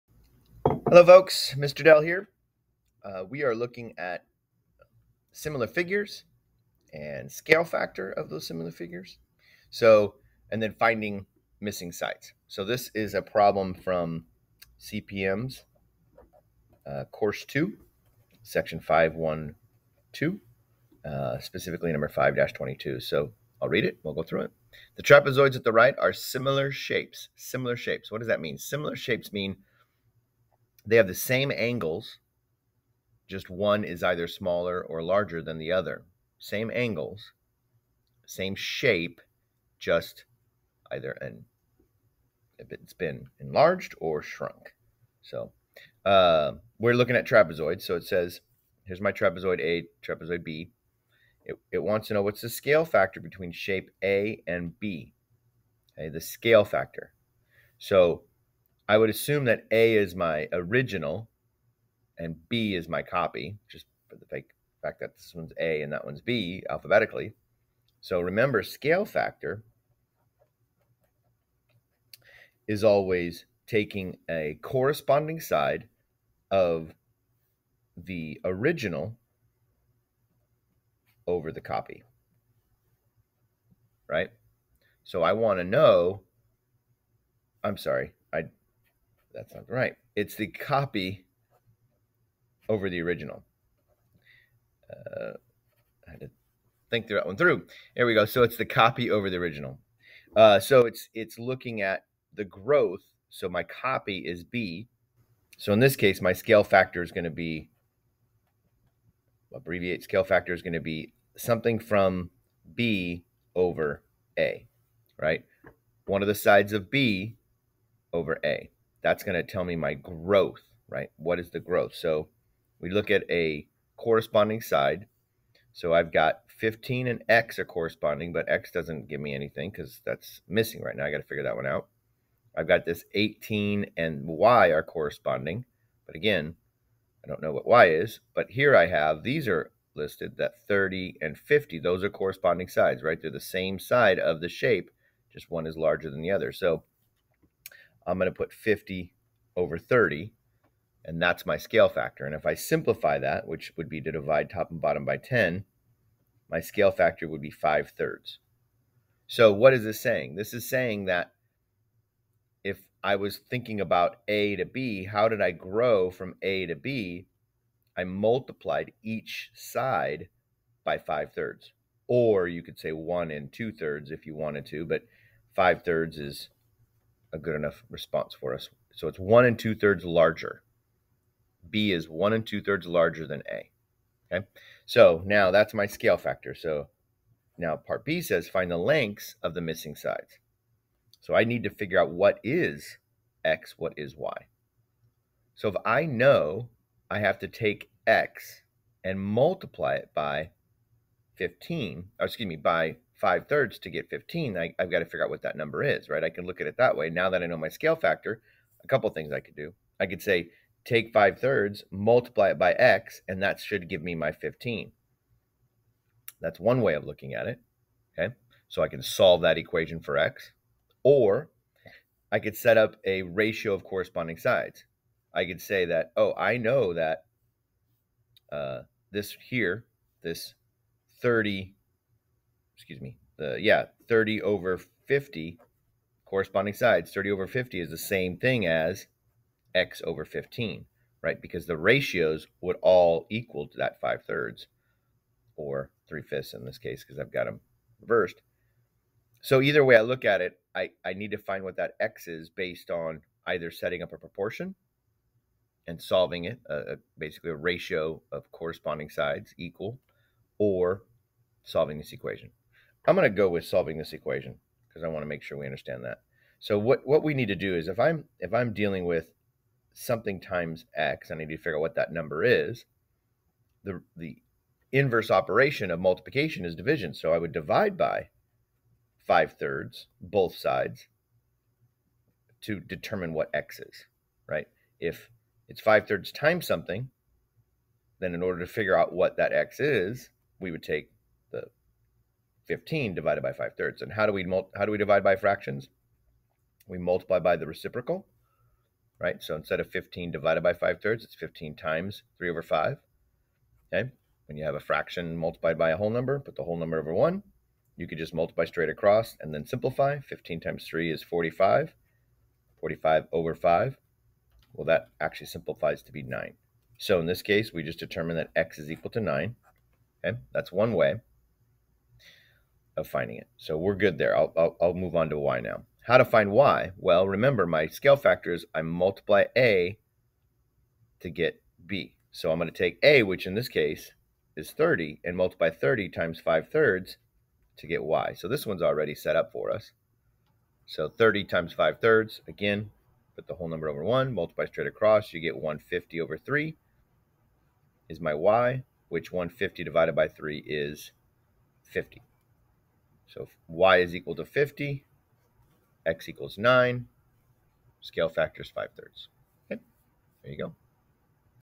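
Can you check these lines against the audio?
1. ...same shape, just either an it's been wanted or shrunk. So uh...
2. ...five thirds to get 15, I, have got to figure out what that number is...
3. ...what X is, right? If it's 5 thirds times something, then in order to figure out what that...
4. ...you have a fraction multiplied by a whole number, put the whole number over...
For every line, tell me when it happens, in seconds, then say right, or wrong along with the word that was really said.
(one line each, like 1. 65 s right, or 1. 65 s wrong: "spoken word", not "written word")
1. 38 s wrong: "enlarged", not "wanted"
2. 203 s right
3. 283 s right
4. 304 s right.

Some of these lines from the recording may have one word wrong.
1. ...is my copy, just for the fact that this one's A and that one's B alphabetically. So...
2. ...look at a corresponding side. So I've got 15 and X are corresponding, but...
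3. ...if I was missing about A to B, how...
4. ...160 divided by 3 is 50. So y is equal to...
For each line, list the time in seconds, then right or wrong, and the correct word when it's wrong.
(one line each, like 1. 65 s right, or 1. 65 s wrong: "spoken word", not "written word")
1. 62 s right
2. 122 s right
3. 162 s wrong: "thinking", not "missing"
4. 349 s wrong: "150", not "160".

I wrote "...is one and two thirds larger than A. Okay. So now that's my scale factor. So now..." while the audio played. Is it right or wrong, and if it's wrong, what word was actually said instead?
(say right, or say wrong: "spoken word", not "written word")
right.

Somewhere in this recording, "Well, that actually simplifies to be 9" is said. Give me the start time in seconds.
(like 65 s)
314 s.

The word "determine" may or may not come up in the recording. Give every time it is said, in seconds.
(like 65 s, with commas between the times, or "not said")
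282 s, 317 s.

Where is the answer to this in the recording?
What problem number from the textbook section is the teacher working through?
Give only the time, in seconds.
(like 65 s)
22 s.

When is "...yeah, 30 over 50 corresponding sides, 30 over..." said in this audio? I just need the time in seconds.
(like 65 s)
233 s.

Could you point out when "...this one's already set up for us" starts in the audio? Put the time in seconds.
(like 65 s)
338 s.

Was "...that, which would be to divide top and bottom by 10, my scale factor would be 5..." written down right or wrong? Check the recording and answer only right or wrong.
right.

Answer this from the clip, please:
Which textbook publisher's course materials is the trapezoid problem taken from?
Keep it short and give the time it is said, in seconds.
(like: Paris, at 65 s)
CPM, at 14 s.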